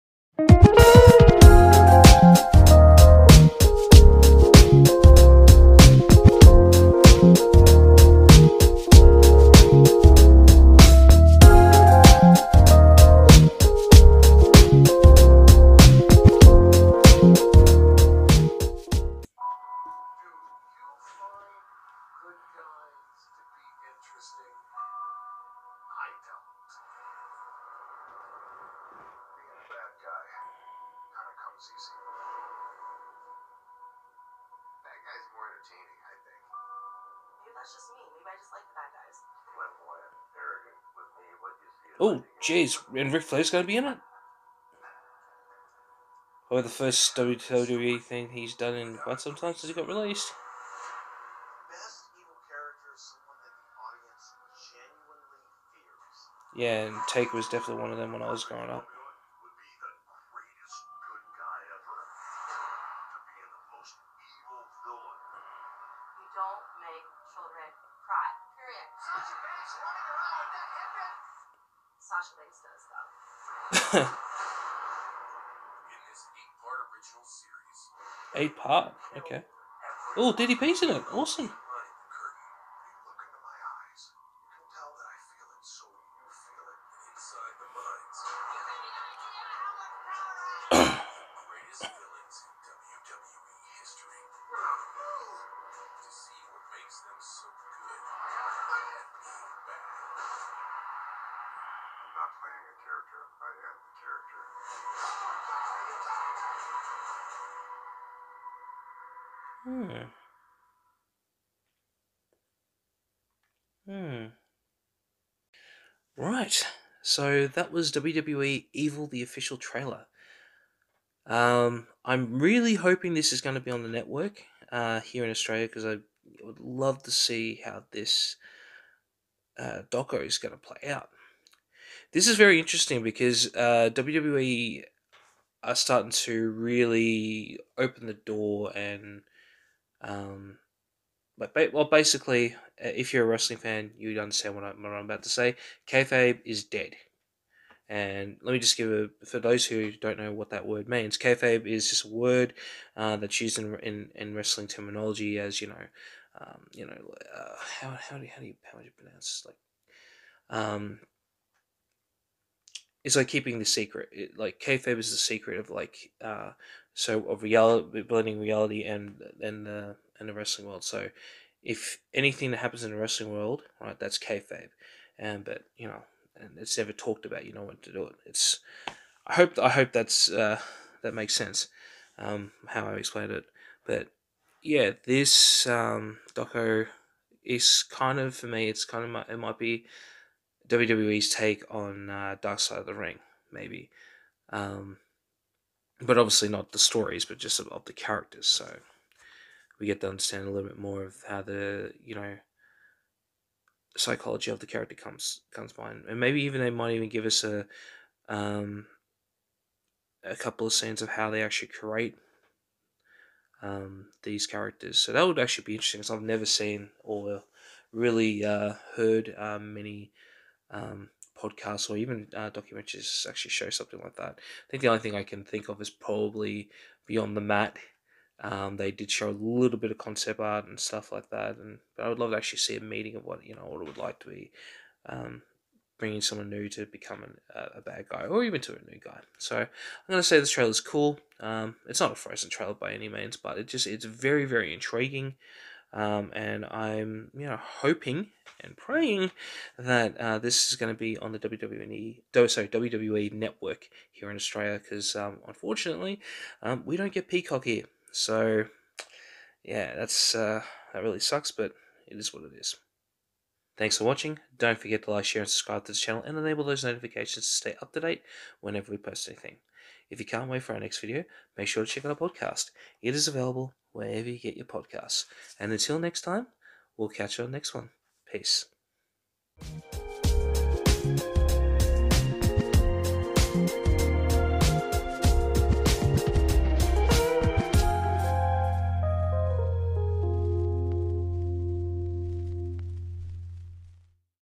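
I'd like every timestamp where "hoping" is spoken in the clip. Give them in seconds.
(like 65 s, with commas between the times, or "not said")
122 s, 247 s.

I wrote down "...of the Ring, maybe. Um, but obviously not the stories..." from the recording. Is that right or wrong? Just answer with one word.
right.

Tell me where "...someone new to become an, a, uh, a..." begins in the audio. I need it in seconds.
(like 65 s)
236 s.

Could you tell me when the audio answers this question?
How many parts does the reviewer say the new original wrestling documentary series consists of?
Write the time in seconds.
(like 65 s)
76 s.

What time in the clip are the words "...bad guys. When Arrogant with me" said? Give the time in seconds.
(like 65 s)
38 s.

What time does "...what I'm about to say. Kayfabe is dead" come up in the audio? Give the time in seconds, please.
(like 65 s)
144 s.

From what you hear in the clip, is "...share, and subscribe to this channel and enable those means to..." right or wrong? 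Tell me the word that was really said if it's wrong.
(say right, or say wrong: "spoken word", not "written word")
wrong: "notifications", not "means".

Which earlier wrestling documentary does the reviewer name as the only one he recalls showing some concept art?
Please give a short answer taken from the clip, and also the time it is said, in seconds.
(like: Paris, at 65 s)
Beyond the Mat, at 227 s.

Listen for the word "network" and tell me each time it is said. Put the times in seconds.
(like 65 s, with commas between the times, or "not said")
123 s, 253 s.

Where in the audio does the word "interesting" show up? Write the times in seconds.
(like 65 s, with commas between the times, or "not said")
132 s, 215 s.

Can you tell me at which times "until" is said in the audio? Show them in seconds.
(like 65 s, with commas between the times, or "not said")
275 s.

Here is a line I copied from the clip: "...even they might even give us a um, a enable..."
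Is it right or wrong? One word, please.
wrong.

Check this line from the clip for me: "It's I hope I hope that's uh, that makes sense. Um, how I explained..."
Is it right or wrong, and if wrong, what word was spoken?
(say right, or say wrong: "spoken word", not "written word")
right.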